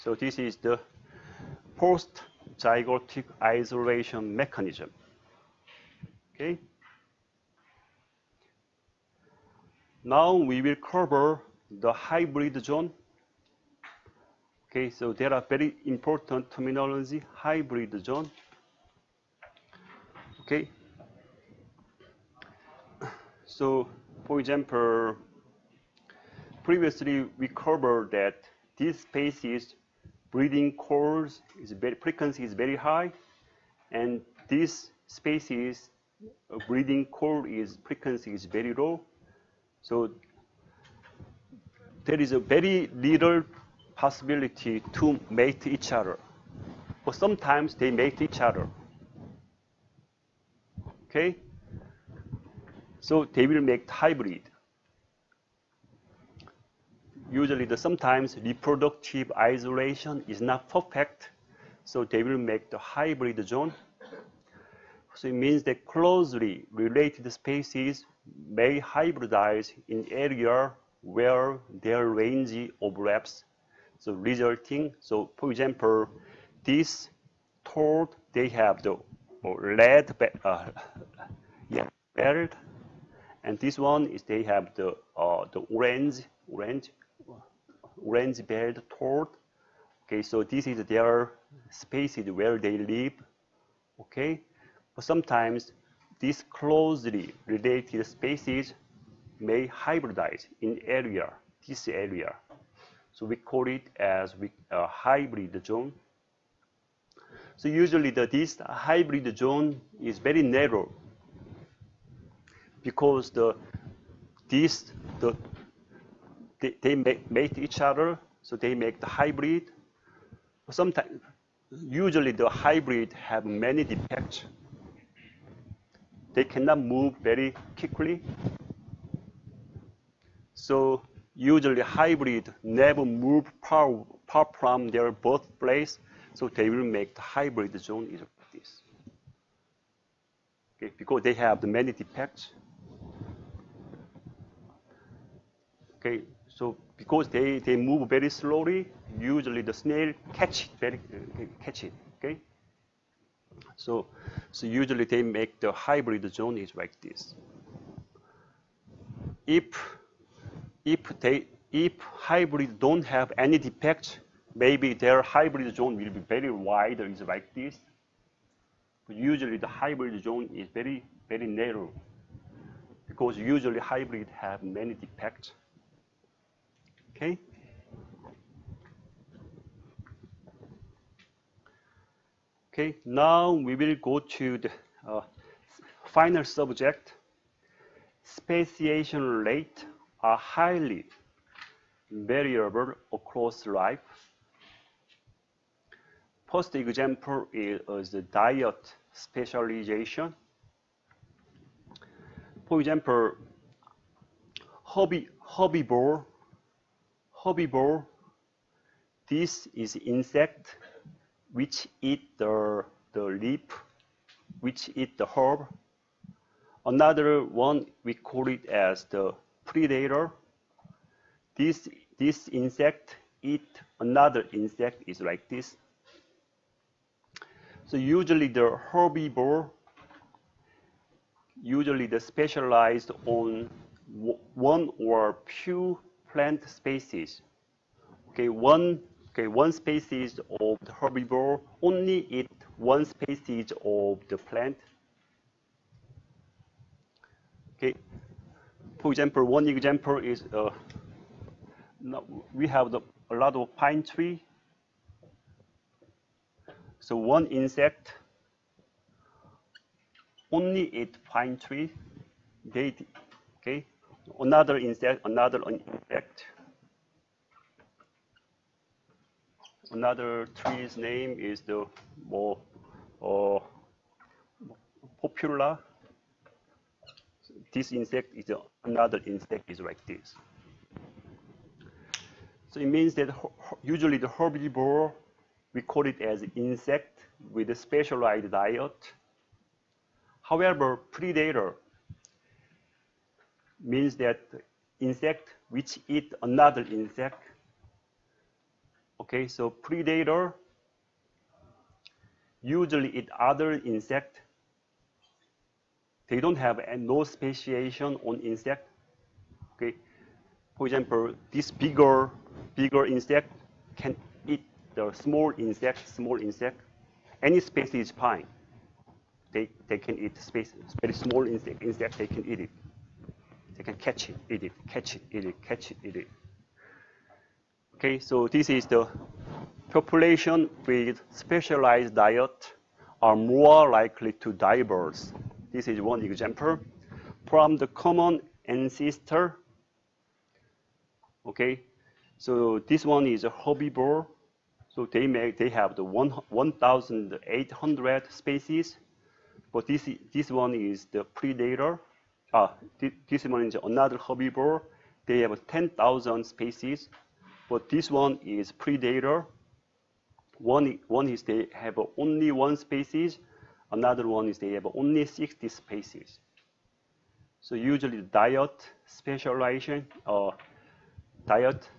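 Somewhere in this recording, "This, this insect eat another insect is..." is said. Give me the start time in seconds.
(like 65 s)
221 s.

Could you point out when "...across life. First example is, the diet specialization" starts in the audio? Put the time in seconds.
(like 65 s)
193 s.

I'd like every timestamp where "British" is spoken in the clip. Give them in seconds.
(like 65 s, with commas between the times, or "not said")
not said.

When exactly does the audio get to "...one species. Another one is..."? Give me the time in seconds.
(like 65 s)
362 s.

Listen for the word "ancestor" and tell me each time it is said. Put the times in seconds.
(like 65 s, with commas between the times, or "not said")
338 s.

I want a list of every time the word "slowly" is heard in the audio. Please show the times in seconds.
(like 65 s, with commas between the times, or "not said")
148 s.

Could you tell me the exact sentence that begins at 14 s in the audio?
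Okay, so there are very important terminology, hybrid zone.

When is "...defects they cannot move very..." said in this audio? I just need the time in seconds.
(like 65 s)
123 s.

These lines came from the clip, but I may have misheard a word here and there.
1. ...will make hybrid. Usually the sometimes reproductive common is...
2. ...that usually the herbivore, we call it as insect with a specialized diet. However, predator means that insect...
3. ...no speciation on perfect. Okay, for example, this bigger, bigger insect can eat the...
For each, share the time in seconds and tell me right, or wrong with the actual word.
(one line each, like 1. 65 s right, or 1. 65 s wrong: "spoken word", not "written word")
1. 53 s wrong: "isolation", not "common"
2. 283 s right
3. 306 s wrong: "insect", not "perfect".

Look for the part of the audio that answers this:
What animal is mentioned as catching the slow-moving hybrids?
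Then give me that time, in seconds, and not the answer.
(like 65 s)
149 s.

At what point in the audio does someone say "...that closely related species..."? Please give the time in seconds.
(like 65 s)
65 s.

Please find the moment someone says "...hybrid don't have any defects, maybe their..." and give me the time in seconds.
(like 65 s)
161 s.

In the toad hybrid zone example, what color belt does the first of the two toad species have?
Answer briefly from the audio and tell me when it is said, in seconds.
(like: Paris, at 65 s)
Red, at 79 s.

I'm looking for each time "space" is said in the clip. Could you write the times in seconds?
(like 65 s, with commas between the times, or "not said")
29 s, 320 s.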